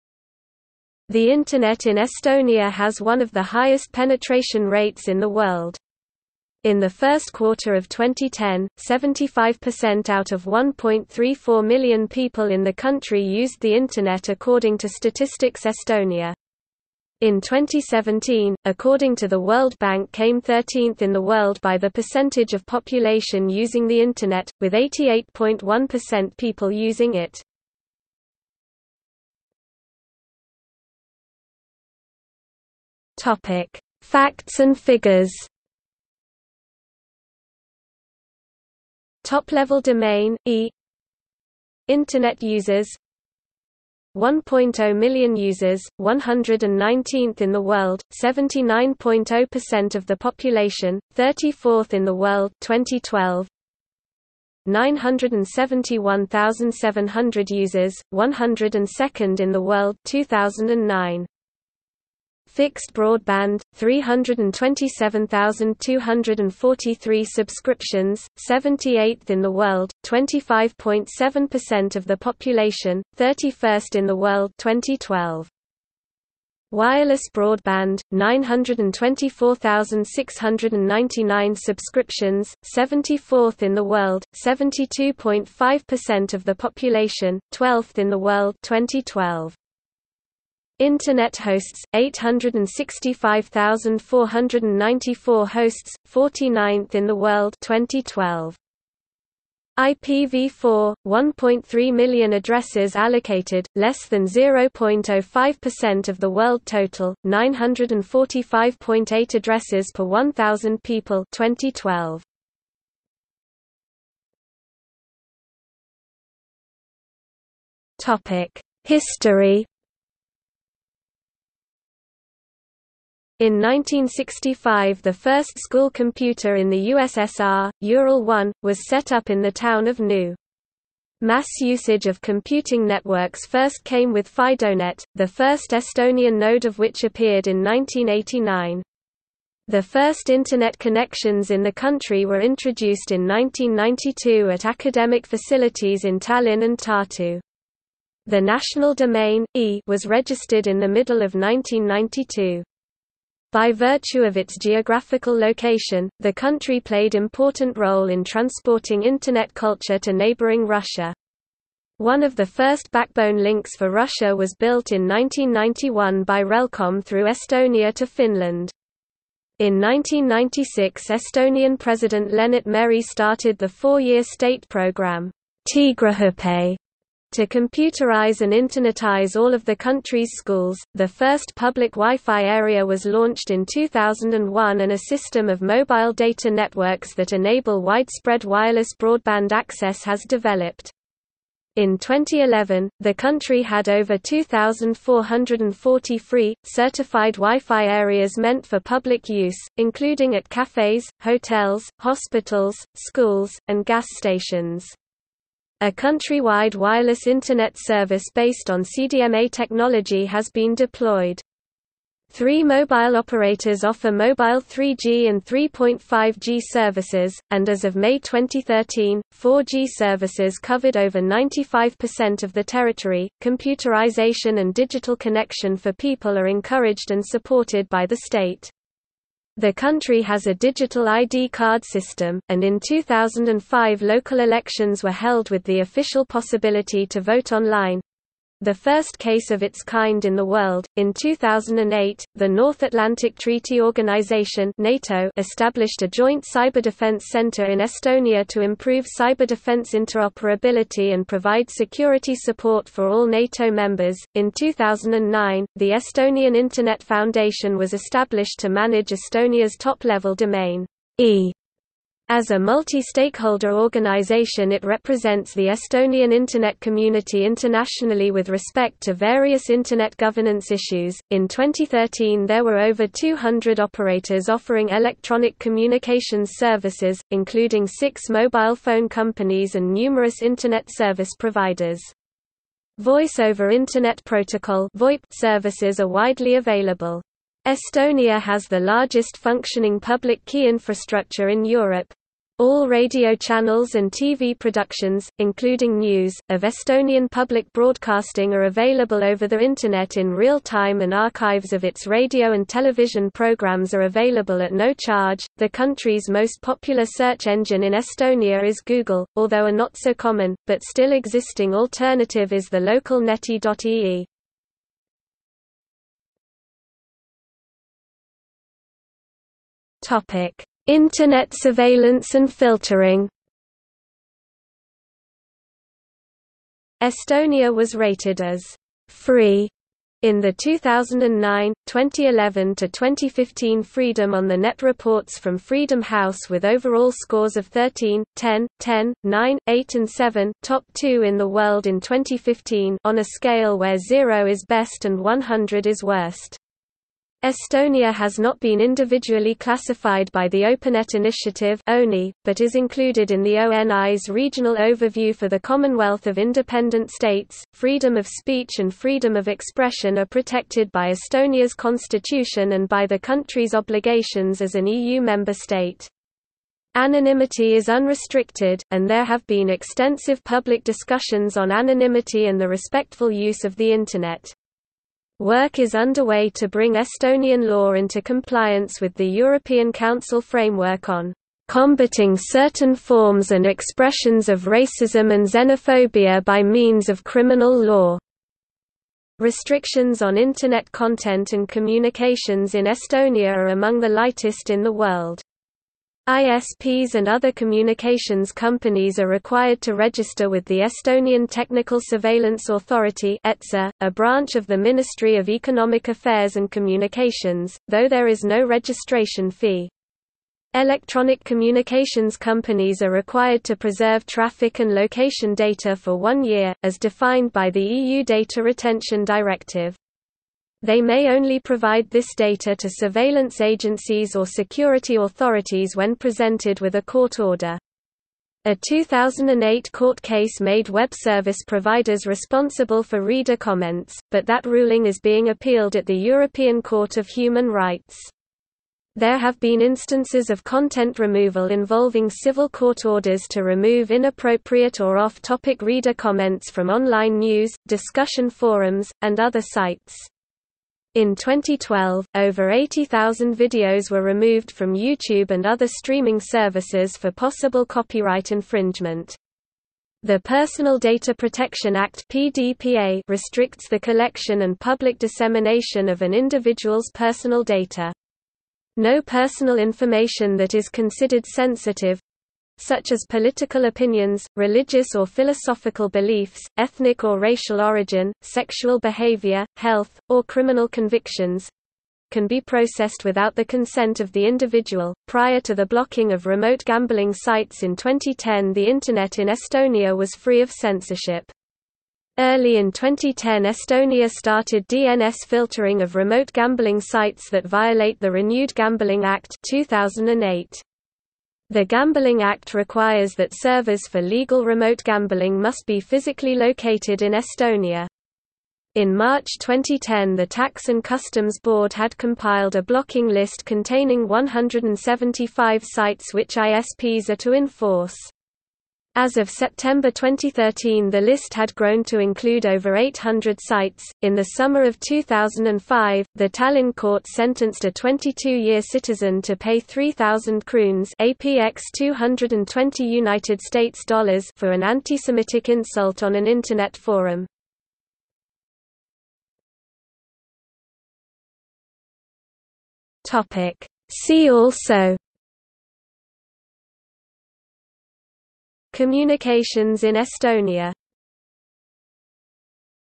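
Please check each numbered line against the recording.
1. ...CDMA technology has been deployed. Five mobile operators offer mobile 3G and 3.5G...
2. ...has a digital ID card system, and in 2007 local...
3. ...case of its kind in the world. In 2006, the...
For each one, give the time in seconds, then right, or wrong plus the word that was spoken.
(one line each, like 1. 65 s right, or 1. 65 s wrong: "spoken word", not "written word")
1. 208 s wrong: "Three", not "Five"
2. 230 s wrong: "2005", not "2007"
3. 239 s wrong: "2008", not "2006".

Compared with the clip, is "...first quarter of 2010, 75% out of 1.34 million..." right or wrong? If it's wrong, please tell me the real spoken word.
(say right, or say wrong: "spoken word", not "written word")
right.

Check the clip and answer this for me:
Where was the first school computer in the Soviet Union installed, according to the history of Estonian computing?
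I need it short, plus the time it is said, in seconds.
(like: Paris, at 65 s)
Nõo, at 129 s.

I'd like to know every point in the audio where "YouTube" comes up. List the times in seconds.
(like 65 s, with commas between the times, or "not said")
454 s.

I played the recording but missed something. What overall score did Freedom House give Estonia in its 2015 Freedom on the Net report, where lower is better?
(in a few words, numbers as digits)
7.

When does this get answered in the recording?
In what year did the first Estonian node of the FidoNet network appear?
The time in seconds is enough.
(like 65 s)
137 s.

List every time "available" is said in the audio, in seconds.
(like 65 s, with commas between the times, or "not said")
286 s, 298 s, 304 s.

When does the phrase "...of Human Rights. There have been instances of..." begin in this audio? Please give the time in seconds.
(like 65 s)
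437 s.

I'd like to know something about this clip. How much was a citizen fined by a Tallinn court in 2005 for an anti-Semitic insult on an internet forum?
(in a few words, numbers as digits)
3,000 kroons.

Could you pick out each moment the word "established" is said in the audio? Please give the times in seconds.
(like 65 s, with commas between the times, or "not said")
245 s, 257 s.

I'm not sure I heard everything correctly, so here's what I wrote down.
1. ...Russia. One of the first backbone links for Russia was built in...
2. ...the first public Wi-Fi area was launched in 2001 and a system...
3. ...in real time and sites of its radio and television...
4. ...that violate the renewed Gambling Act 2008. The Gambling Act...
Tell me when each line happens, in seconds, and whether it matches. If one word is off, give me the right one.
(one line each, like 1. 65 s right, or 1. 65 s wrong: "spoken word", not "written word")
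1. 160 s right
2. 180 s right
3. 300 s wrong: "archives", not "sites"
4. 497 s right.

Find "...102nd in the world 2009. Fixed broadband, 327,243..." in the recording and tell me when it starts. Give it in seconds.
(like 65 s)
58 s.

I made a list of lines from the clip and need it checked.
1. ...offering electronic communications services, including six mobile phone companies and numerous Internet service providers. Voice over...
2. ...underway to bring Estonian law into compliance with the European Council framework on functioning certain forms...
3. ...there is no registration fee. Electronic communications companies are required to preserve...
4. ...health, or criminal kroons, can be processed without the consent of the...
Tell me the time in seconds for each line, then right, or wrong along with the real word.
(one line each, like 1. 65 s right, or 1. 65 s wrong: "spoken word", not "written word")
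1. 274 s right
2. 375 s wrong: "combating", not "functioning"
3. 408 s right
4. 479 s wrong: "convictions", not "kroons".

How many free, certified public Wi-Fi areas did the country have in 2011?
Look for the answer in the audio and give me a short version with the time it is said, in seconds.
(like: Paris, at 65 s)
2,440, at 194 s.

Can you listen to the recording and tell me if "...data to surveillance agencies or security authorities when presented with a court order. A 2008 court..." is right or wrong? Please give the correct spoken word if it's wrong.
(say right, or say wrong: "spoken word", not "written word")
right.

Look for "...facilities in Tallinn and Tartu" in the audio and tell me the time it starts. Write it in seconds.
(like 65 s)
145 s.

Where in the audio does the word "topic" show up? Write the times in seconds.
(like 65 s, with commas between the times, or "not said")
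33 s, 118 s, 320 s, 445 s, 543 s.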